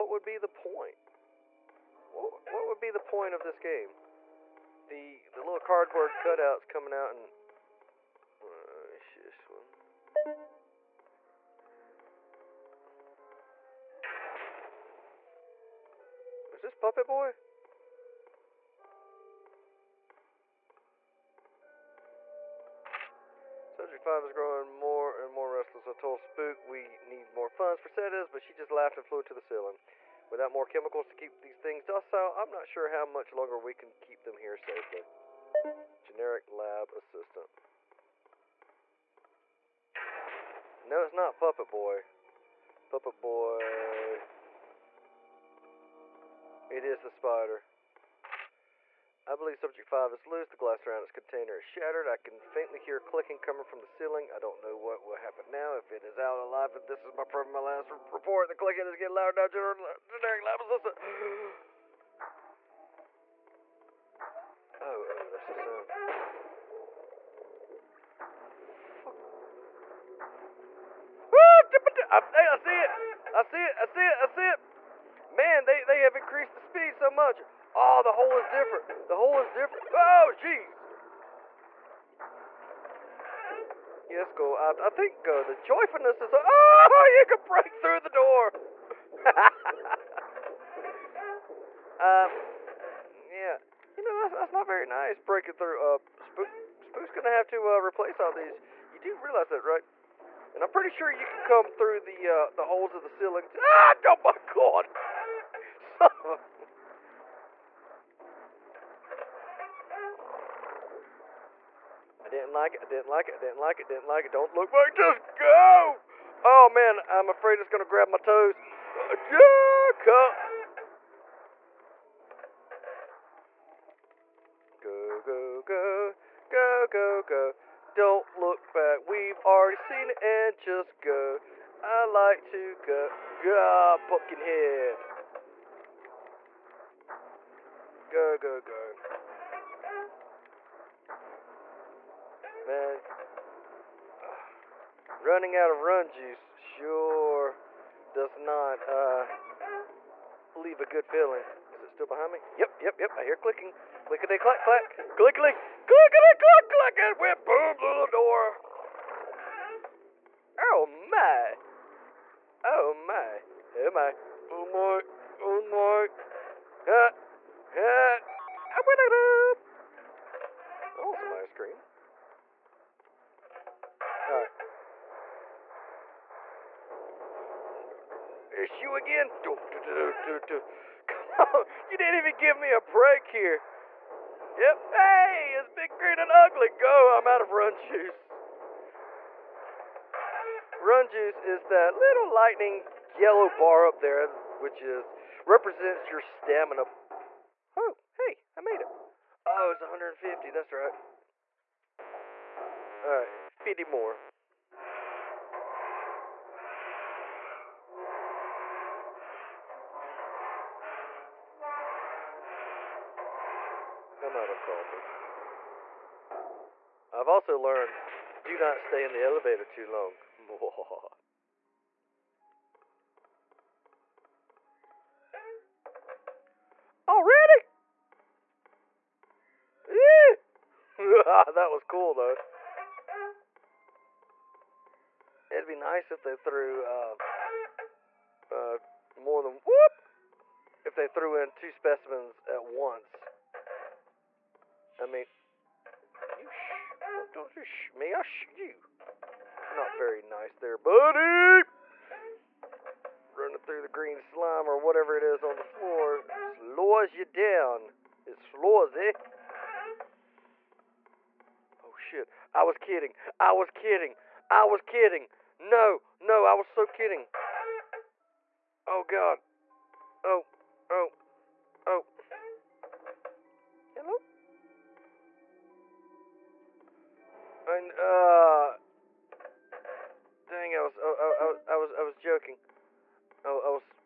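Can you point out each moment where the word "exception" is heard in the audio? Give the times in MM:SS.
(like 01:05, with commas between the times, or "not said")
not said.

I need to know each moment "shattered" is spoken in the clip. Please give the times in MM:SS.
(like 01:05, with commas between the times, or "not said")
00:51.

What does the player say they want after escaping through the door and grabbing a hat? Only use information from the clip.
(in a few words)
ice cream.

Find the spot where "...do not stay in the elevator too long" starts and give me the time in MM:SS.
03:38.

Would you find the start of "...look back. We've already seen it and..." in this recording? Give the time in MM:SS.
02:08.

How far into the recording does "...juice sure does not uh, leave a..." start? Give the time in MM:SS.
02:26.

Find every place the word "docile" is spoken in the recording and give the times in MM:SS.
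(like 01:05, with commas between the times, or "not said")
00:31.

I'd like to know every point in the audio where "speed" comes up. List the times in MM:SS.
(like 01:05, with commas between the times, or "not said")
01:16.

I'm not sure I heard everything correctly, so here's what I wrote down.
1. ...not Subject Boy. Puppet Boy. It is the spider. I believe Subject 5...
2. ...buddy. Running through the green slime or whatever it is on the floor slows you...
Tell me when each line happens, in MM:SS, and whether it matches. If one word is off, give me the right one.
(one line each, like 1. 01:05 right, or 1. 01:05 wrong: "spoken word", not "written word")
1. 00:41 wrong: "Puppet", not "Subject"
2. 04:10 right.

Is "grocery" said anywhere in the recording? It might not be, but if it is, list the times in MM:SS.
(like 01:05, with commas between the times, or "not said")
not said.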